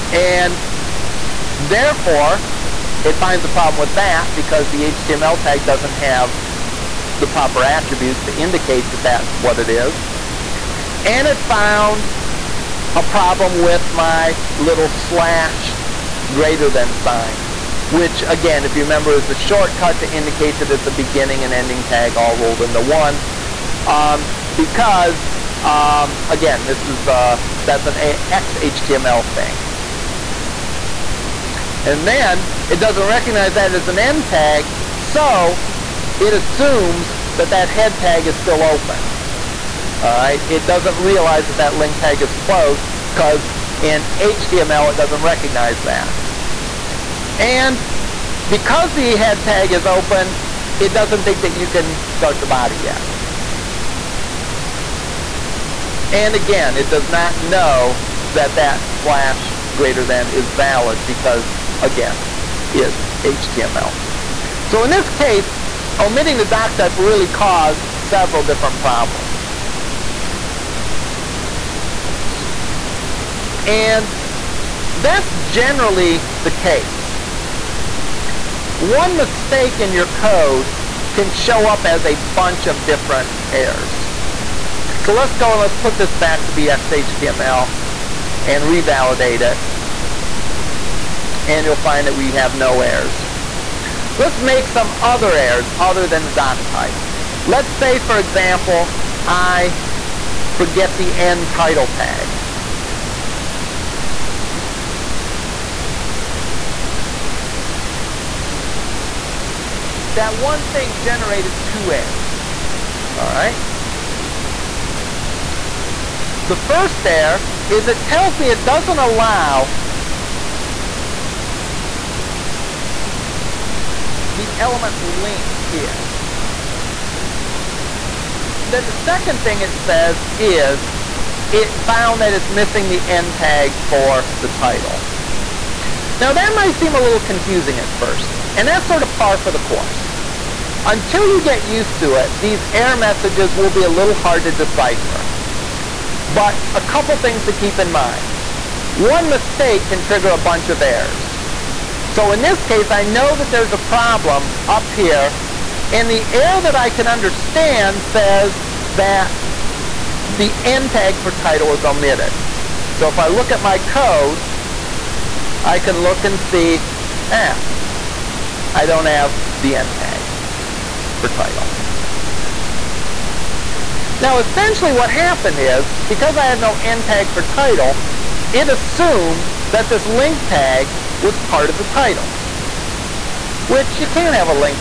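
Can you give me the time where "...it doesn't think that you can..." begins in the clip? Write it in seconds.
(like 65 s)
50 s.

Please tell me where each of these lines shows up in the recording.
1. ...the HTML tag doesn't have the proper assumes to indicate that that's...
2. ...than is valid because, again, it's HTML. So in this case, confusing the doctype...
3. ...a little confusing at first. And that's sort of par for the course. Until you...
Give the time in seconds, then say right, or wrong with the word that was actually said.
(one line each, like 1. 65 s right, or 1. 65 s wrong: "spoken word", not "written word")
1. 4 s wrong: "attributes", not "assumes"
2. 60 s wrong: "omitting", not "confusing"
3. 136 s right.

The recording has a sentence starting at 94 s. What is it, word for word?
Let's make some other errors other than the doc type.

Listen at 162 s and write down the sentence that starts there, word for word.
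So if I look at my code, I can look and see, ah, eh, I don't have the end tag for title.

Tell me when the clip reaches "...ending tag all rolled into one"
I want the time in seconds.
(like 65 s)
21 s.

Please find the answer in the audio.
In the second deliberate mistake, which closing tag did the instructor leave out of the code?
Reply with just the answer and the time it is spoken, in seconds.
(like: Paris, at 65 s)
The end title tag, at 101 s.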